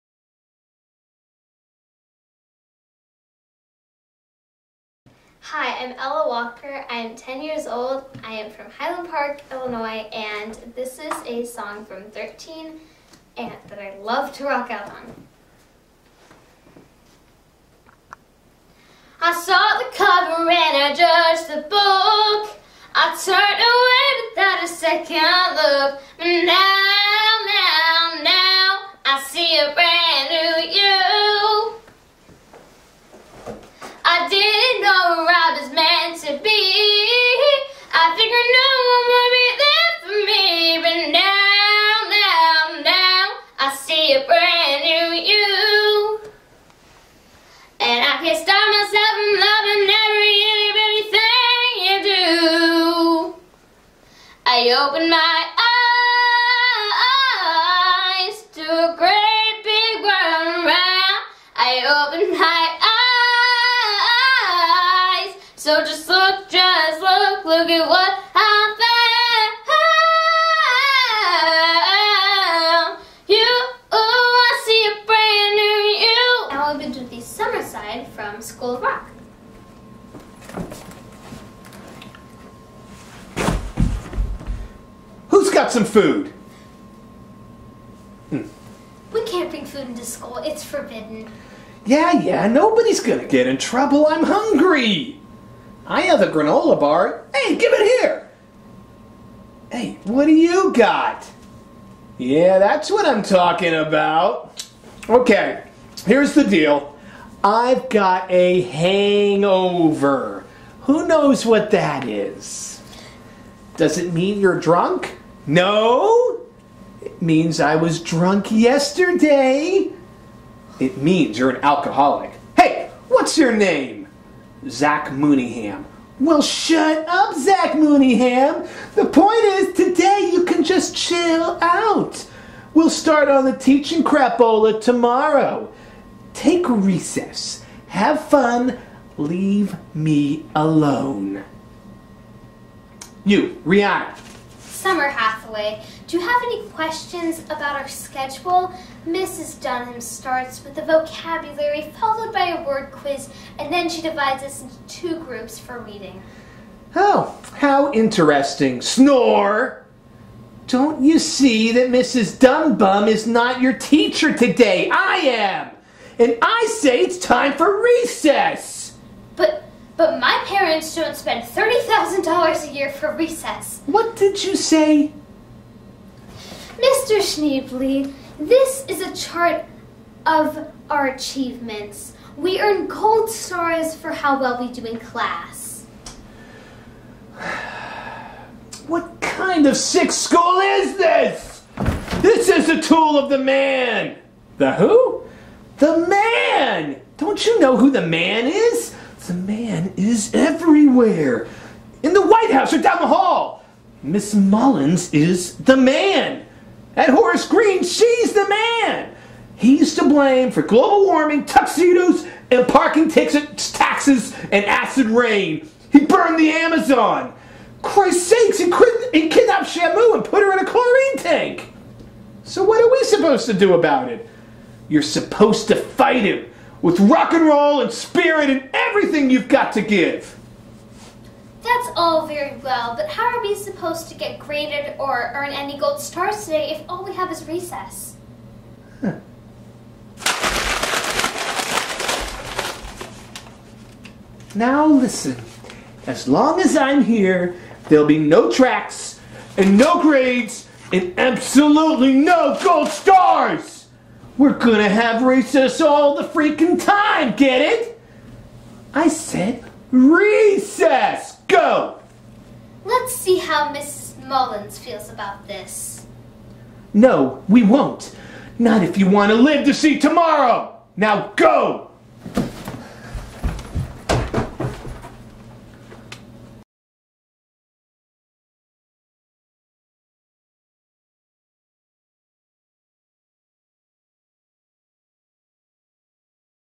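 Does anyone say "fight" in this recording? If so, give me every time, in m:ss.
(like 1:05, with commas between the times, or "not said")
3:45.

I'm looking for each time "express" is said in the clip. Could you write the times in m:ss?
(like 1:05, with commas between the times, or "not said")
not said.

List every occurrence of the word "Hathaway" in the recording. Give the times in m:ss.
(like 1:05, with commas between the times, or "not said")
2:25.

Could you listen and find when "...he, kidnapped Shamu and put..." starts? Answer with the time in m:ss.
3:38.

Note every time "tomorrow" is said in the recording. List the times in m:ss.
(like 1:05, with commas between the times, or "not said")
2:14, 4:29.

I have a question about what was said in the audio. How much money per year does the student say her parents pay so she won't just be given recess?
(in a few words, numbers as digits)
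$30,000.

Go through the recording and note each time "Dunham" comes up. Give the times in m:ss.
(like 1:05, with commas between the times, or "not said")
2:29.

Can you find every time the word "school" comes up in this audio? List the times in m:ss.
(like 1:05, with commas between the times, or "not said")
1:30, 3:10.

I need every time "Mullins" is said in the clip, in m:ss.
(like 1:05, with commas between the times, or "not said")
3:24, 4:24.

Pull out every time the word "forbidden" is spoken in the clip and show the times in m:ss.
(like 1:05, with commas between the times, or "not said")
1:30.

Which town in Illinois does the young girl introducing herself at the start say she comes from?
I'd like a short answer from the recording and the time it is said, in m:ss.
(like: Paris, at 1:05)
Highland Park, at 0:08.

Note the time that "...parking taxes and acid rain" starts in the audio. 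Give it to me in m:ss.
3:32.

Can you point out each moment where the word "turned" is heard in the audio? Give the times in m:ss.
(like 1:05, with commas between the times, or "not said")
0:23.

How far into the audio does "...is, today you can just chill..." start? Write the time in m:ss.
2:09.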